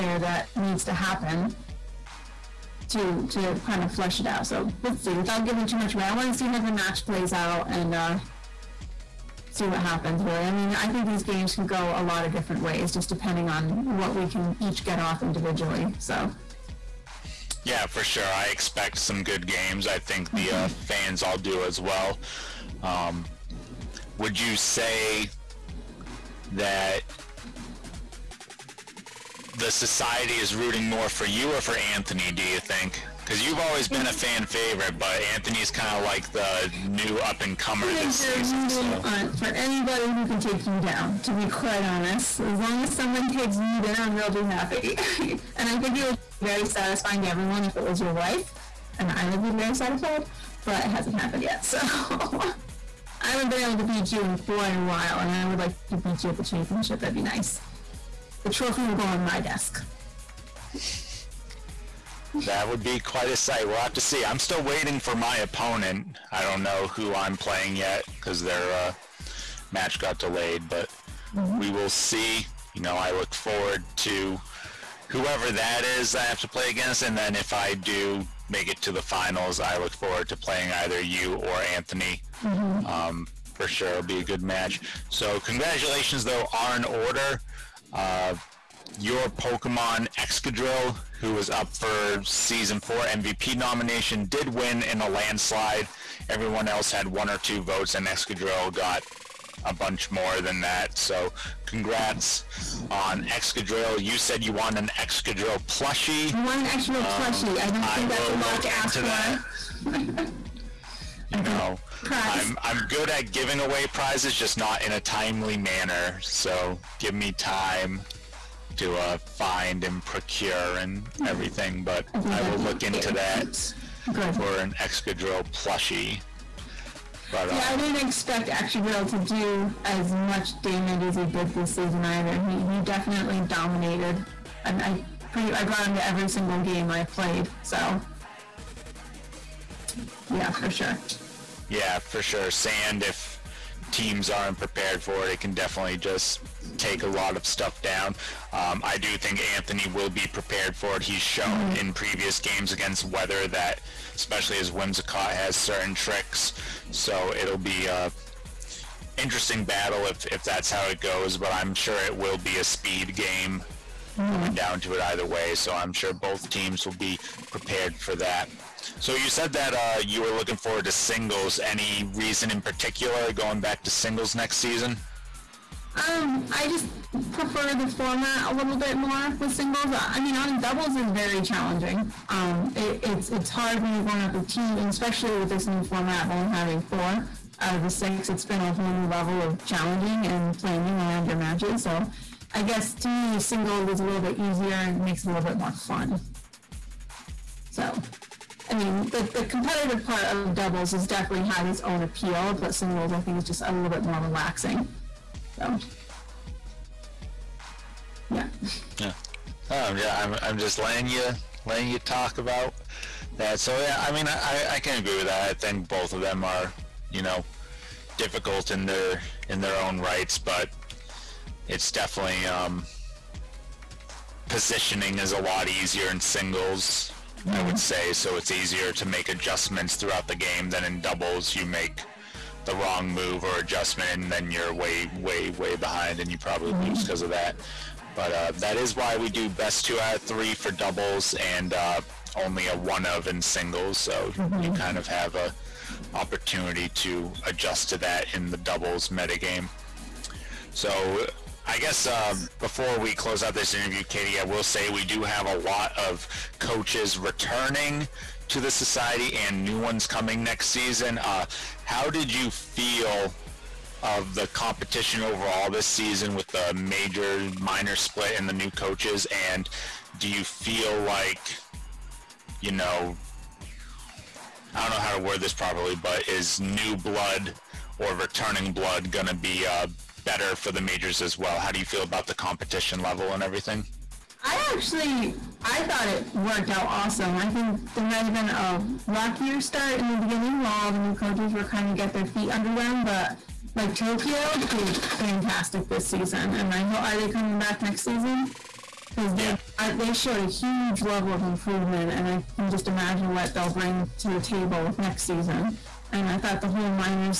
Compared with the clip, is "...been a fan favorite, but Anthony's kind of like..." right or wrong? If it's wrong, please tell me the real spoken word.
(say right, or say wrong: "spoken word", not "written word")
right.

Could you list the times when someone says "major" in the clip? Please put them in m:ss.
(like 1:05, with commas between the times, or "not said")
4:26, 4:40.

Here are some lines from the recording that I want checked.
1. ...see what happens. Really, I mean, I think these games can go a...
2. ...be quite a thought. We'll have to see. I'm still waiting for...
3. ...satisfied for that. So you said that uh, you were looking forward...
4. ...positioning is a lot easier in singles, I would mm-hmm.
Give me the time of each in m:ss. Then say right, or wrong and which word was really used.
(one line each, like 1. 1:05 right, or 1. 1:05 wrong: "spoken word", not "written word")
1. 0:09 right
2. 1:02 wrong: "sight", not "thought"
3. 2:47 wrong: "prepared", not "satisfied"
4. 3:44 right.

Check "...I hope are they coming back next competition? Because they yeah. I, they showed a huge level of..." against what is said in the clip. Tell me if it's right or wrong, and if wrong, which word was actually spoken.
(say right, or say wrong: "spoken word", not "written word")
wrong: "season", not "competition".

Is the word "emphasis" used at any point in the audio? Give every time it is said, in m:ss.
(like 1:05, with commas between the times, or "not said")
not said.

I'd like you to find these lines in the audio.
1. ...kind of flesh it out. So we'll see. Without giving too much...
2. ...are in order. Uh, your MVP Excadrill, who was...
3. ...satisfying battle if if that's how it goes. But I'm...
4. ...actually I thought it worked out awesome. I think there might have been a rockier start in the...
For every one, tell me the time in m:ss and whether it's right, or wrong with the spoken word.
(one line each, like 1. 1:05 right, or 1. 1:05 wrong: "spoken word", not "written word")
1. 0:03 right
2. 1:26 wrong: "Pokemon", not "MVP"
3. 2:39 wrong: "interesting", not "satisfying"
4. 4:44 right.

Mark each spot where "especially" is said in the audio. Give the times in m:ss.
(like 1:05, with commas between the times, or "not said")
2:34, 3:04.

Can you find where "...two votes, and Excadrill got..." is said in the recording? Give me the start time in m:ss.
1:37.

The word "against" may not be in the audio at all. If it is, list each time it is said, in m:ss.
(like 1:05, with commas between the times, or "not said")
1:16, 2:32.